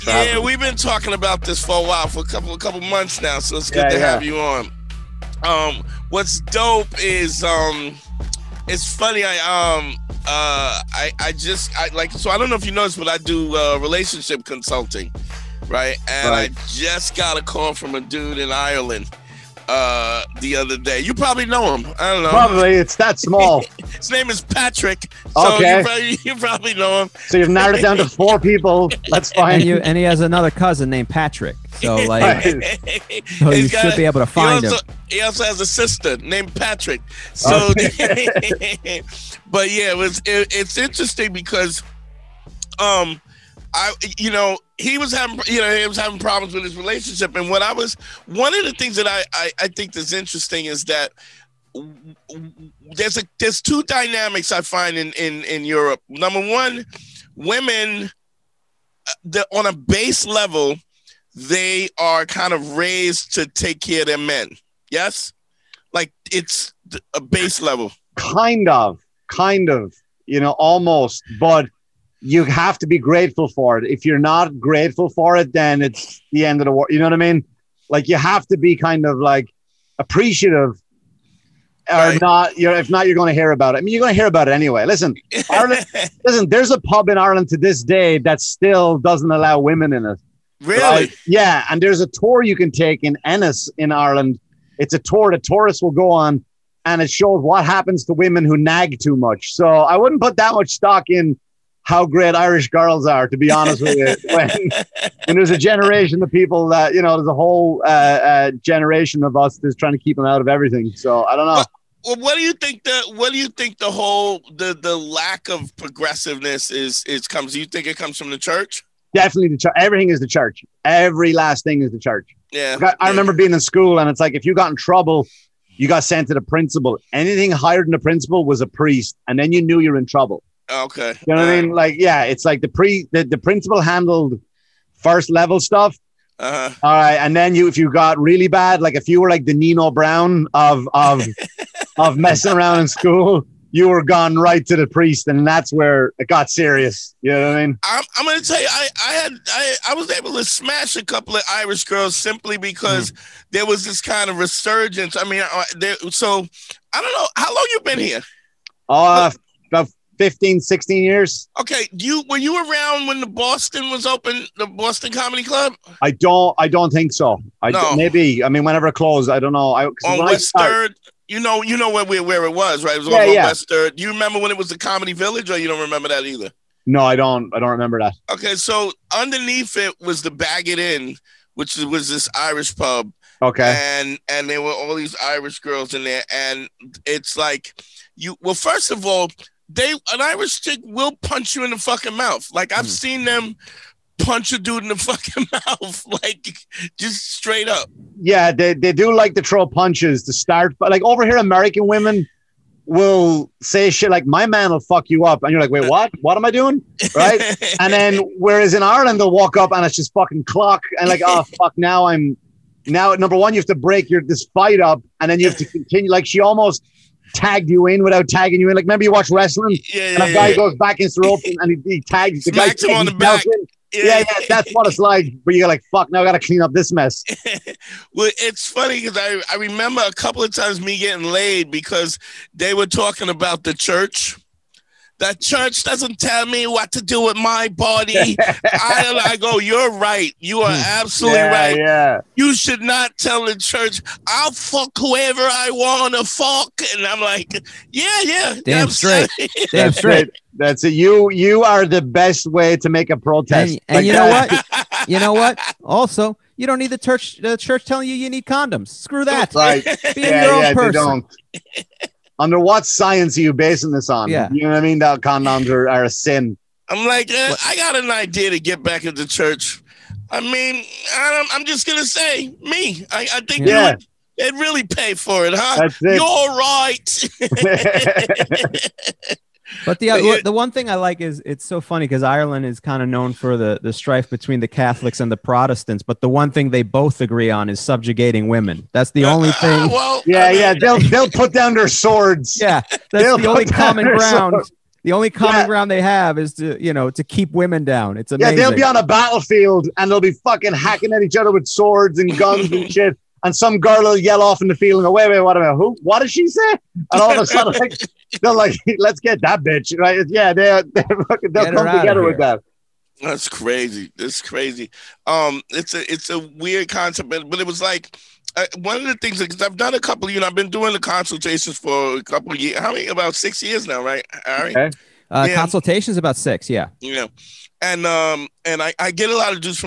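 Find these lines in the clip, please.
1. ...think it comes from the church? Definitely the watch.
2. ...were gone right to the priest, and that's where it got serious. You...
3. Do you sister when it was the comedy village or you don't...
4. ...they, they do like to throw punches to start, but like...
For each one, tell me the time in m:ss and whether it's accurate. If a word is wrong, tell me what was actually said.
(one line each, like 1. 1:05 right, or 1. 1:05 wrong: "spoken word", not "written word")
1. 1:57 wrong: "church", not "watch"
2. 2:23 right
3. 2:53 wrong: "remember", not "sister"
4. 3:18 right.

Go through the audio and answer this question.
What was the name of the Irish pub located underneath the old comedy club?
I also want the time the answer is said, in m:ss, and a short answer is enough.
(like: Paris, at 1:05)
Bag It In, at 3:00.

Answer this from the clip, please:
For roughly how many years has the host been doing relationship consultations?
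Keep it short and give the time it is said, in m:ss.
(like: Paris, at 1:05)
About 6 years, at 5:23.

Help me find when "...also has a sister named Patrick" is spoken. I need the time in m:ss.
0:35.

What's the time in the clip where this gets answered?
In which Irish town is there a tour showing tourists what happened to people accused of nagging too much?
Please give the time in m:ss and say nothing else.
1:33.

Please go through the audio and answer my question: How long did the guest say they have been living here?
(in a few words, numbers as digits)
15, 16 years.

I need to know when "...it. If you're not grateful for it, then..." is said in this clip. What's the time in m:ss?
1:13.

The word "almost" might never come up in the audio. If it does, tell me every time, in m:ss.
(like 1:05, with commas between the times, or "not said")
1:10, 3:36.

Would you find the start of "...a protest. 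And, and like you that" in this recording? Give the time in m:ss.
4:13.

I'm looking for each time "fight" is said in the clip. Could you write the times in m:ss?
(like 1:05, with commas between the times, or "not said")
3:34.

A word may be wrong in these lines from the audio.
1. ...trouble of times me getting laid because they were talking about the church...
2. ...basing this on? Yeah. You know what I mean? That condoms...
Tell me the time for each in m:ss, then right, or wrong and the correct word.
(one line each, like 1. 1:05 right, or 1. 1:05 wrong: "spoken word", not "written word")
1. 3:50 wrong: "couple", not "trouble"
2. 4:23 right.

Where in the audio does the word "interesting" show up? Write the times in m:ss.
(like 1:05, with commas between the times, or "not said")
0:40, 0:50.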